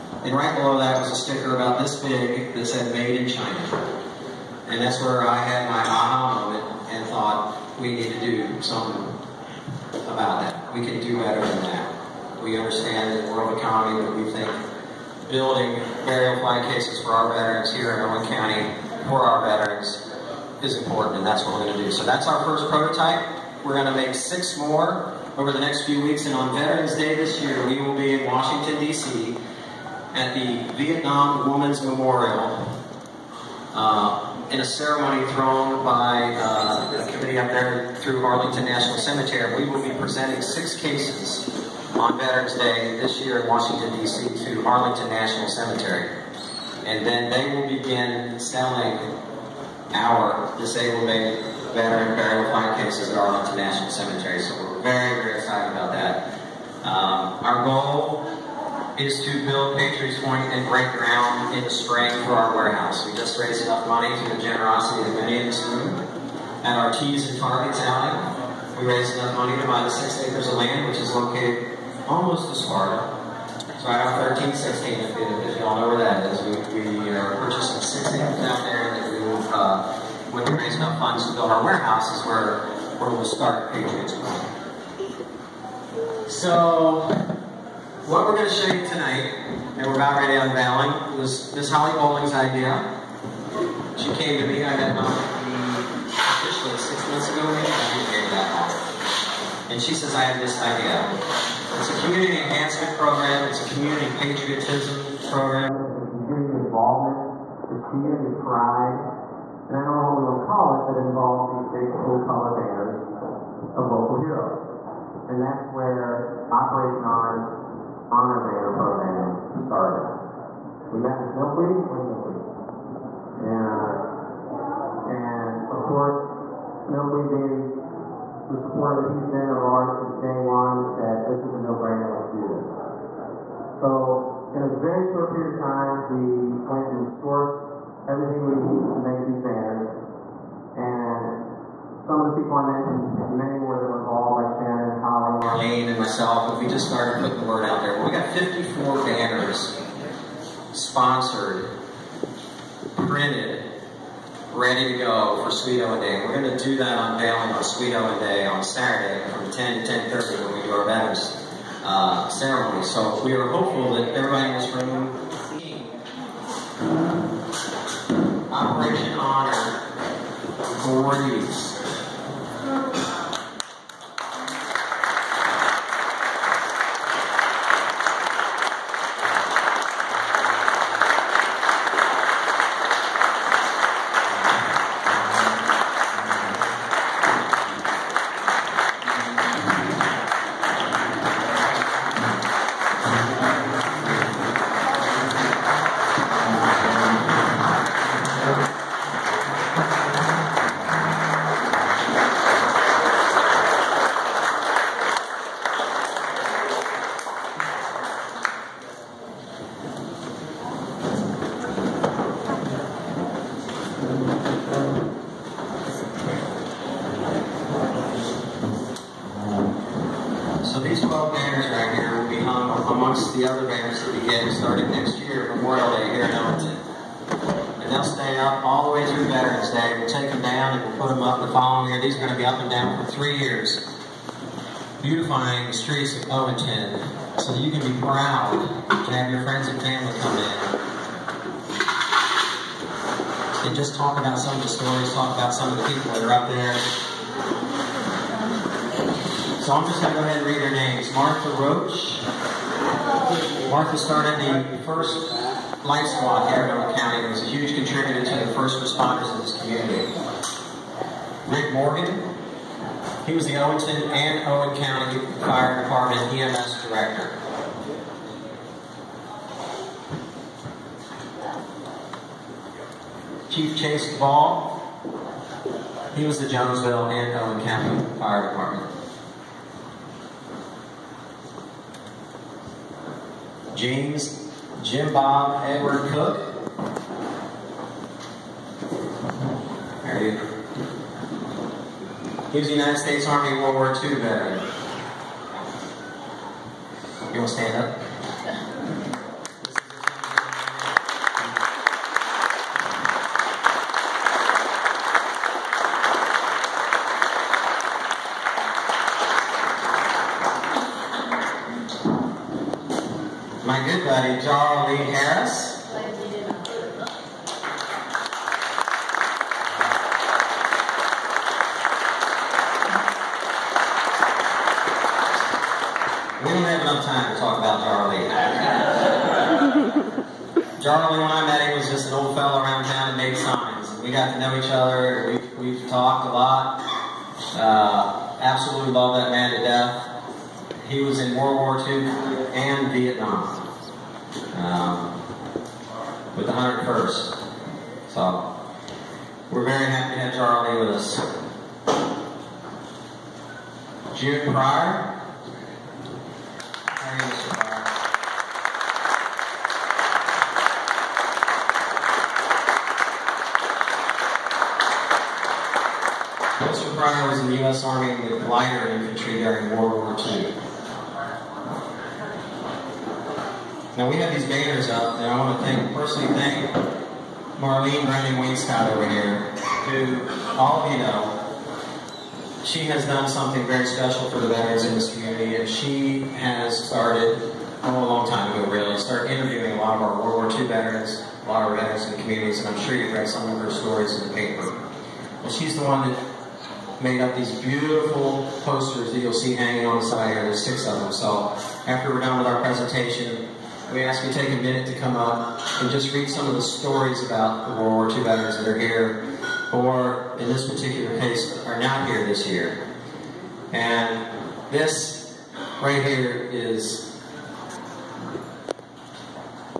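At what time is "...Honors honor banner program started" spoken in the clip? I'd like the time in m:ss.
1:57.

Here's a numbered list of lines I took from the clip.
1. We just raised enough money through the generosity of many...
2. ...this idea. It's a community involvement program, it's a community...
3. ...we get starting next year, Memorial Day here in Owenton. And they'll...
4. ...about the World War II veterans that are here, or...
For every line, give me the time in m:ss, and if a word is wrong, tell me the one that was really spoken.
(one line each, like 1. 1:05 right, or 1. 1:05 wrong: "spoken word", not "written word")
1. 1:03 right
2. 1:40 wrong: "enhancement", not "involvement"
3. 3:44 right
4. 6:47 right.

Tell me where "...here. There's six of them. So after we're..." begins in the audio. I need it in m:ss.
6:40.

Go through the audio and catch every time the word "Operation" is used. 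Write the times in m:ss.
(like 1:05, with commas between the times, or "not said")
1:56, 2:48.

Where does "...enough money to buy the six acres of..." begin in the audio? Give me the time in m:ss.
1:09.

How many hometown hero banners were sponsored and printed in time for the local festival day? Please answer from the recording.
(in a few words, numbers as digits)
54.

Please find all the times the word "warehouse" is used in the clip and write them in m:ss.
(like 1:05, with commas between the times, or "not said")
1:02, 1:21.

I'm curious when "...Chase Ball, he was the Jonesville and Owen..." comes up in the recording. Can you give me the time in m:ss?
4:33.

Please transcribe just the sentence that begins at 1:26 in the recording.
So, what we're going to show you tonight, and we're about ready unveiling, was Miss Holly Bowling's idea.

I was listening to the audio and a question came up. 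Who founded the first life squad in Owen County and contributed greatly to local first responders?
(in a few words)
Martha Roach.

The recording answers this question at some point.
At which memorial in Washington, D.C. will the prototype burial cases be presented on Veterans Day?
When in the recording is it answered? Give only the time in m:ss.
0:30.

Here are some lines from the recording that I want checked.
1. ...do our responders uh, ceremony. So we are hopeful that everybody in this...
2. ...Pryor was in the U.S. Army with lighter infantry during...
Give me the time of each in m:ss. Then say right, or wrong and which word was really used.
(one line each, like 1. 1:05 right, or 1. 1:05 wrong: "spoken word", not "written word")
1. 2:40 wrong: "banners", not "responders"
2. 6:06 right.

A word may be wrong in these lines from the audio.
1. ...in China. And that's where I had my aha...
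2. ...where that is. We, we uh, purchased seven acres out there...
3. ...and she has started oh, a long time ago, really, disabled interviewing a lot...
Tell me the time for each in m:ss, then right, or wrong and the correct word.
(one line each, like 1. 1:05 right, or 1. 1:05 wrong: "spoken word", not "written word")
1. 0:03 right
2. 1:15 wrong: "six", not "seven"
3. 6:25 wrong: "started", not "disabled".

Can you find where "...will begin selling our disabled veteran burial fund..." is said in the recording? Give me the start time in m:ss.
0:47.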